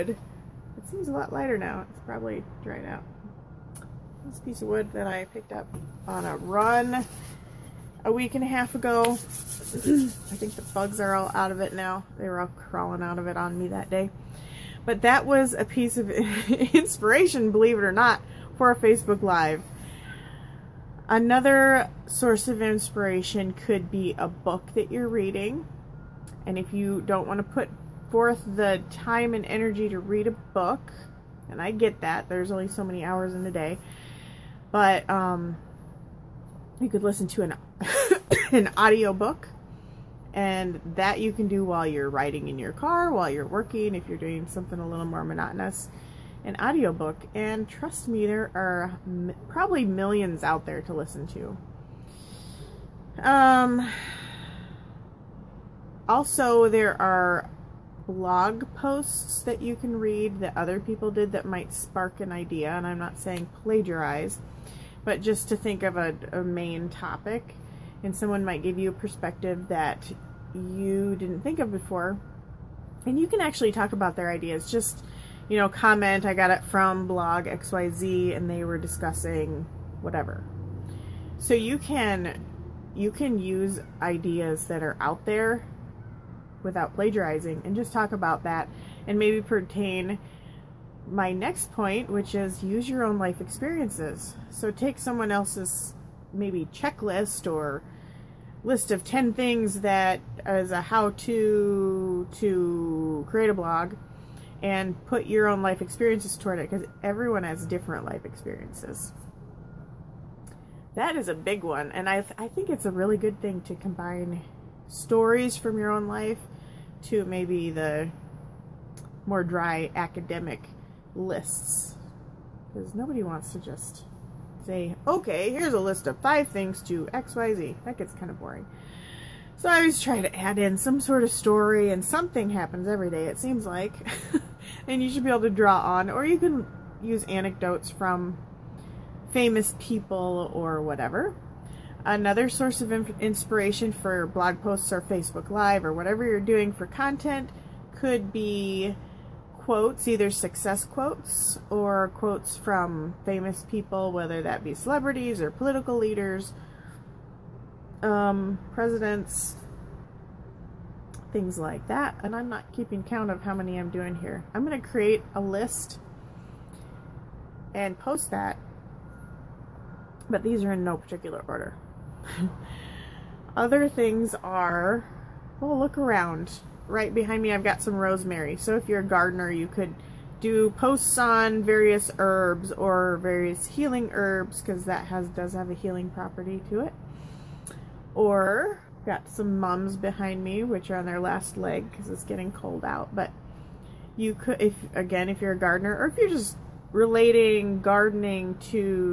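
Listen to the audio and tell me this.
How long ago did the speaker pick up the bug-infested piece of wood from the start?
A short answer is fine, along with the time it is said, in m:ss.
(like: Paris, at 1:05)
A week and a half, at 0:08.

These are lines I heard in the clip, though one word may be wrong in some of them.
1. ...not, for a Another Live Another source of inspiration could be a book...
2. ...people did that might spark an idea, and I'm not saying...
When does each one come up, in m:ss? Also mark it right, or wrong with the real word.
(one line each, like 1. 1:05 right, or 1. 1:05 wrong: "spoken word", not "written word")
1. 0:17 wrong: "Facebook", not "Another"
2. 1:00 right.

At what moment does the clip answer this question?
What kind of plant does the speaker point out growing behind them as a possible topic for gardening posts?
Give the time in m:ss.
2:57.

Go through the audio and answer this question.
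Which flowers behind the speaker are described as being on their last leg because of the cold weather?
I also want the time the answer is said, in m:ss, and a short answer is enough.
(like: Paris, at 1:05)
Mums, at 3:09.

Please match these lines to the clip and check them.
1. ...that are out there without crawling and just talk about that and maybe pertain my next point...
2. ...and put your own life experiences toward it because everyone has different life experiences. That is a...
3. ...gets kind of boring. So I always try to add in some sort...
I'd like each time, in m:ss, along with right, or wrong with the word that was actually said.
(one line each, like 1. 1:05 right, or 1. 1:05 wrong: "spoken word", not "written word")
1. 1:24 wrong: "plagiarizing", not "crawling"
2. 1:44 right
3. 2:07 right.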